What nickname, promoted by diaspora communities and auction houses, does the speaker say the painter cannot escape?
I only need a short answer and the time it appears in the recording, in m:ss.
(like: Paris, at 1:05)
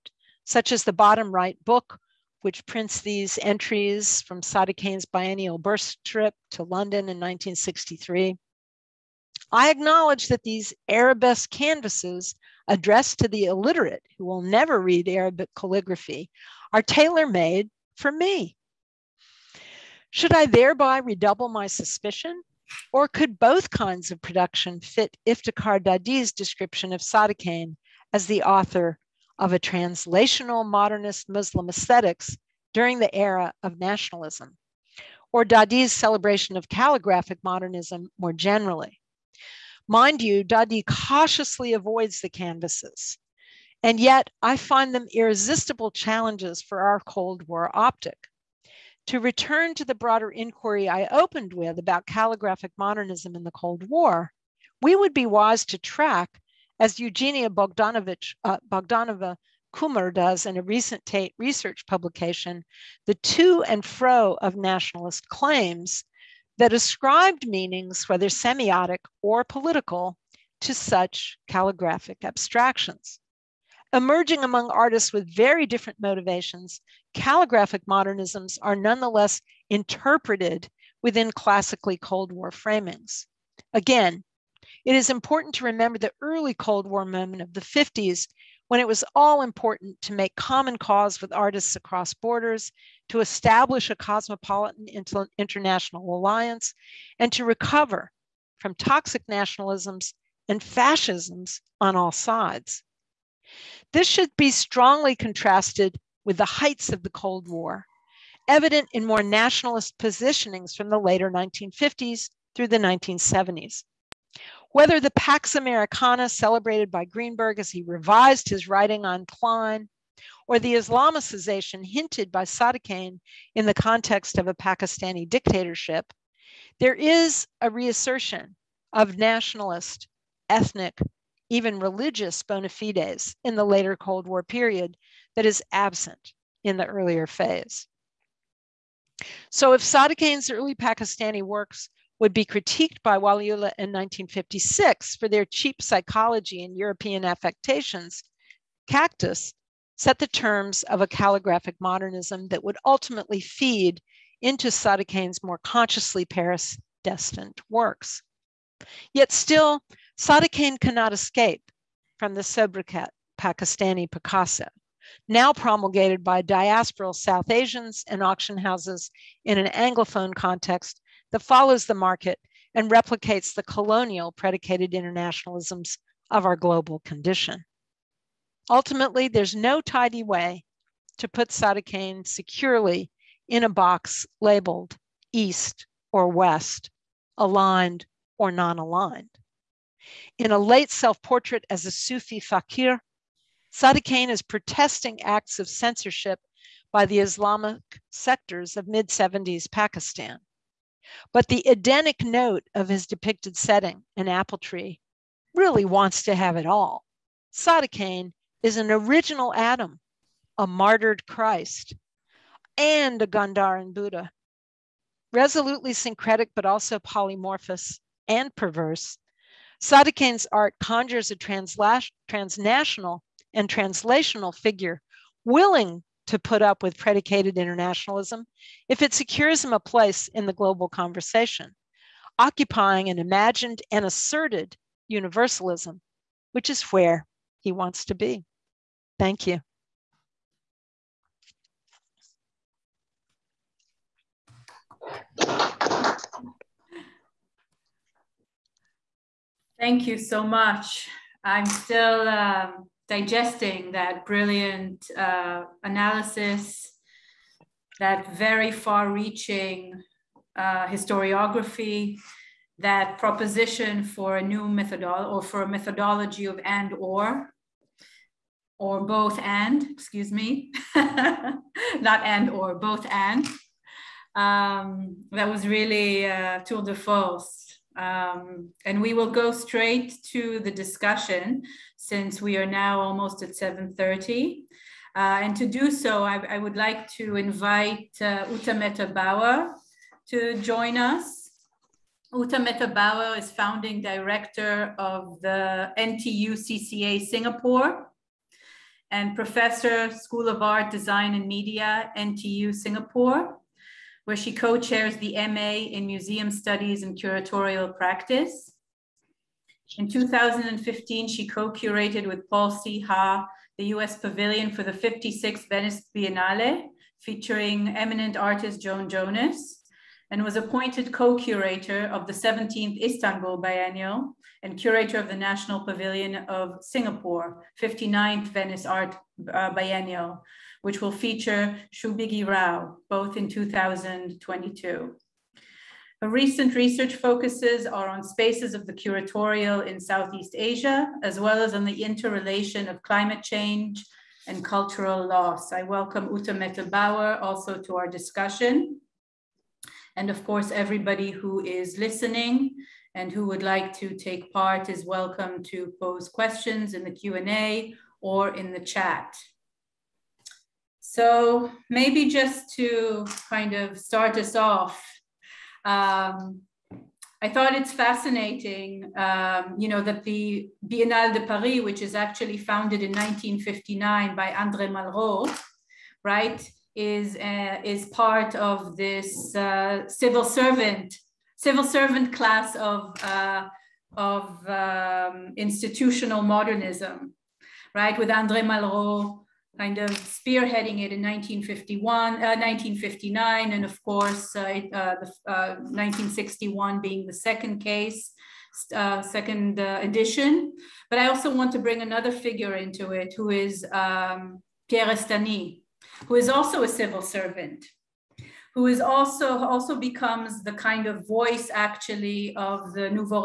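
Pakistani Picasso, at 2:43.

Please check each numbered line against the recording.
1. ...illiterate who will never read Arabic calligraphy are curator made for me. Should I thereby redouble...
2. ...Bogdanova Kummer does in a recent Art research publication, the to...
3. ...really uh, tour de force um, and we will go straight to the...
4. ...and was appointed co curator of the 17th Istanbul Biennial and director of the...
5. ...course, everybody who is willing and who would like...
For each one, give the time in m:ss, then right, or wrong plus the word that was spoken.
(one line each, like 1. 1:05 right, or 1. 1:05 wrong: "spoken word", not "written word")
1. 0:13 wrong: "tailor", not "curator"
2. 0:58 wrong: "Tate", not "Art"
3. 4:35 right
4. 5:20 wrong: "curator", not "director"
5. 5:50 wrong: "listening", not "willing".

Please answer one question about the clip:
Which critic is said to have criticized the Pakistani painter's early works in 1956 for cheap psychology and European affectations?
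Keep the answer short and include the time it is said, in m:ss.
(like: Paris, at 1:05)
Waliullah, at 2:23.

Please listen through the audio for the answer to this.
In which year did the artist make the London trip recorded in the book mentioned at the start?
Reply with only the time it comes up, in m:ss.
0:07.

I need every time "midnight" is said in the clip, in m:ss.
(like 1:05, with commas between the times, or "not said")
not said.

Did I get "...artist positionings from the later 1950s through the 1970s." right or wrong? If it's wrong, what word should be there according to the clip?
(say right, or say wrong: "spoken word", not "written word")
wrong: "nationalist", not "artist".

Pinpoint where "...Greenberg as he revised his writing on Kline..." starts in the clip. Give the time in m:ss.
1:57.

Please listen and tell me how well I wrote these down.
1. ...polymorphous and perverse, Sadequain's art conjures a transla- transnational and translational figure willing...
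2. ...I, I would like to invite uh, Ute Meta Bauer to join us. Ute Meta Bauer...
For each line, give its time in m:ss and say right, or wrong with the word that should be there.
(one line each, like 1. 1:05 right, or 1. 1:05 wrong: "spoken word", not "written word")
1. 3:36 right
2. 4:46 right.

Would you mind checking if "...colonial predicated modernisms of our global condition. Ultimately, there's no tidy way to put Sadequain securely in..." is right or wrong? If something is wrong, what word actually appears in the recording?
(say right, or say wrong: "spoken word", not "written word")
wrong: "internationalisms", not "modernisms".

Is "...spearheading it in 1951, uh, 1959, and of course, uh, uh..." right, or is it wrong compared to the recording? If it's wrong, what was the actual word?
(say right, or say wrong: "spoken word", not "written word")
right.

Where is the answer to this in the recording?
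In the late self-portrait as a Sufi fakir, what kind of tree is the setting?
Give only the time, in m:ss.
3:24.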